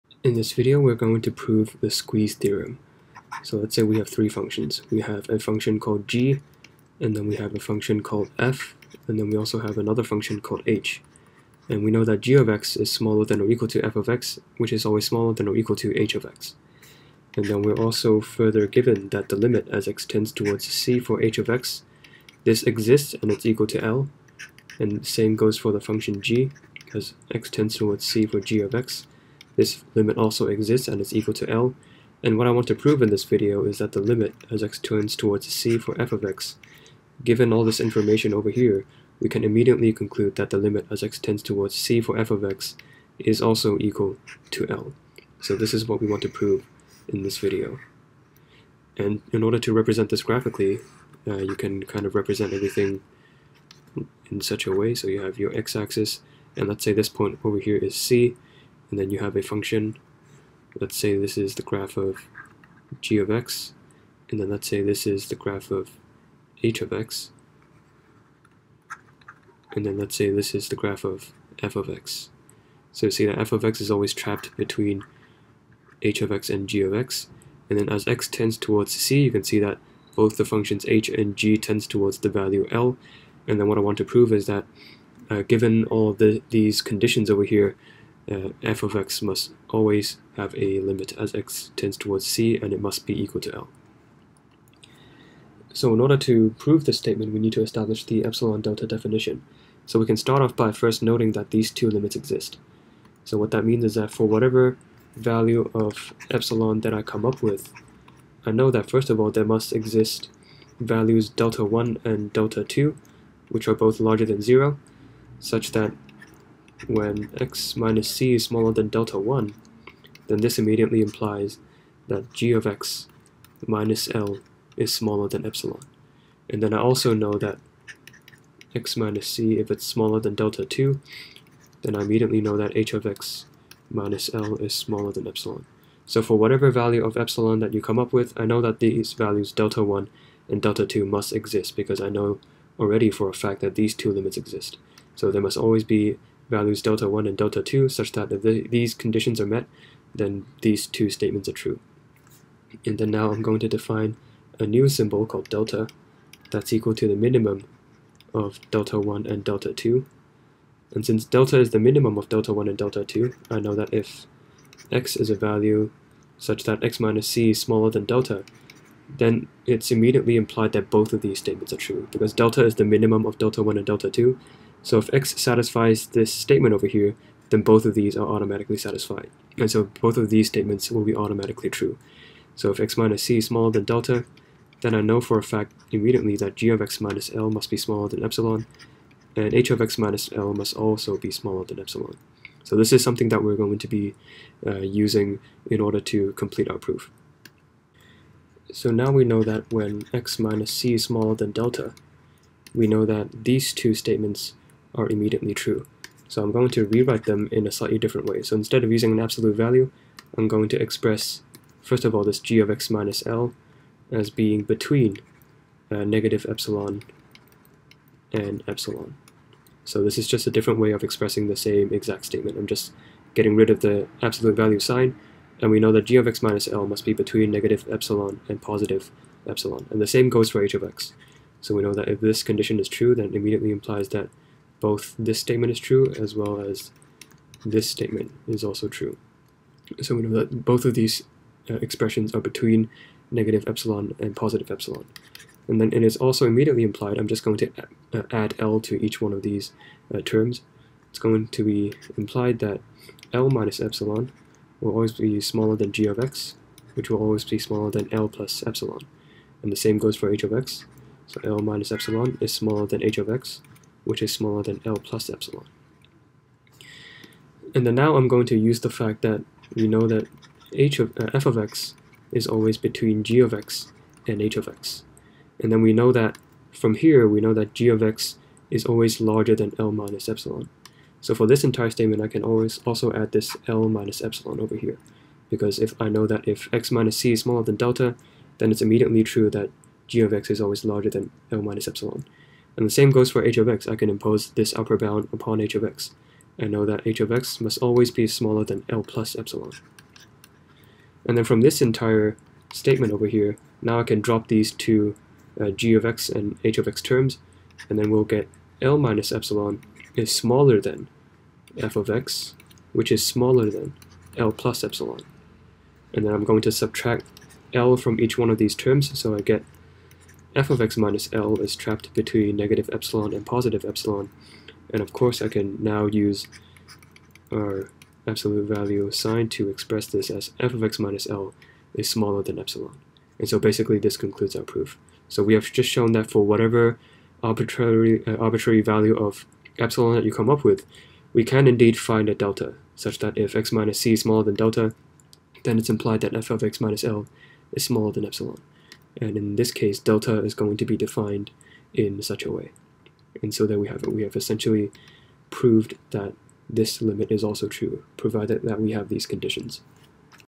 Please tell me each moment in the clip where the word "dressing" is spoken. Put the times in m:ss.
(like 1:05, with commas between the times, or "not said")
not said.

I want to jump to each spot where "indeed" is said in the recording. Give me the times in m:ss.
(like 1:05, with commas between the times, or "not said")
5:41.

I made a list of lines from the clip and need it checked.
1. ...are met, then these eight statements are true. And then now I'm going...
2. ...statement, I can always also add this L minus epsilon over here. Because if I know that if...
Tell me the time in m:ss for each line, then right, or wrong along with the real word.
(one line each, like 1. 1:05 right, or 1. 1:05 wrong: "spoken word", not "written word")
1. 2:29 wrong: "two", not "eight"
2. 4:41 right.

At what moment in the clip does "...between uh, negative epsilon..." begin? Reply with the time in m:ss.
3:34.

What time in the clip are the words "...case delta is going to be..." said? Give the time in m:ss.
5:49.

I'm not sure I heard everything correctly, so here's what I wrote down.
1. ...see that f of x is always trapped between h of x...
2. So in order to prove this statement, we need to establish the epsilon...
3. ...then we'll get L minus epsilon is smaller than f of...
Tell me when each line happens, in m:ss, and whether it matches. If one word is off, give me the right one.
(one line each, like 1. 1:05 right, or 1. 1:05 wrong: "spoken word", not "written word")
1. 1:13 right
2. 1:35 right
3. 5:07 right.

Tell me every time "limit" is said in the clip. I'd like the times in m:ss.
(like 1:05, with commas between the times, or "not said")
0:19, 0:29, 0:33, 0:40, 1:30, 1:41, 2:24, 5:57.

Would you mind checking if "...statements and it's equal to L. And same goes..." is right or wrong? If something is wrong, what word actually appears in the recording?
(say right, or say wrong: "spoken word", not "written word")
wrong: "exists", not "statements".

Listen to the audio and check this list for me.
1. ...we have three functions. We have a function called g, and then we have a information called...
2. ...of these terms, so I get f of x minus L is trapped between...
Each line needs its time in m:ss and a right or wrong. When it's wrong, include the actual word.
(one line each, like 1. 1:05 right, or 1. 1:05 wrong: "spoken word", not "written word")
1. 0:03 wrong: "function", not "information"
2. 5:18 right.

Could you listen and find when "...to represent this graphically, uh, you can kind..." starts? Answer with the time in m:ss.
0:49.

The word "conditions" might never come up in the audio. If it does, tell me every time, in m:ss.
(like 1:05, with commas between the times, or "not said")
1:26, 2:28, 3:52, 5:59.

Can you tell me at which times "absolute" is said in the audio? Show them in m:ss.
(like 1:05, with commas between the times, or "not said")
3:29, 3:44, 5:28.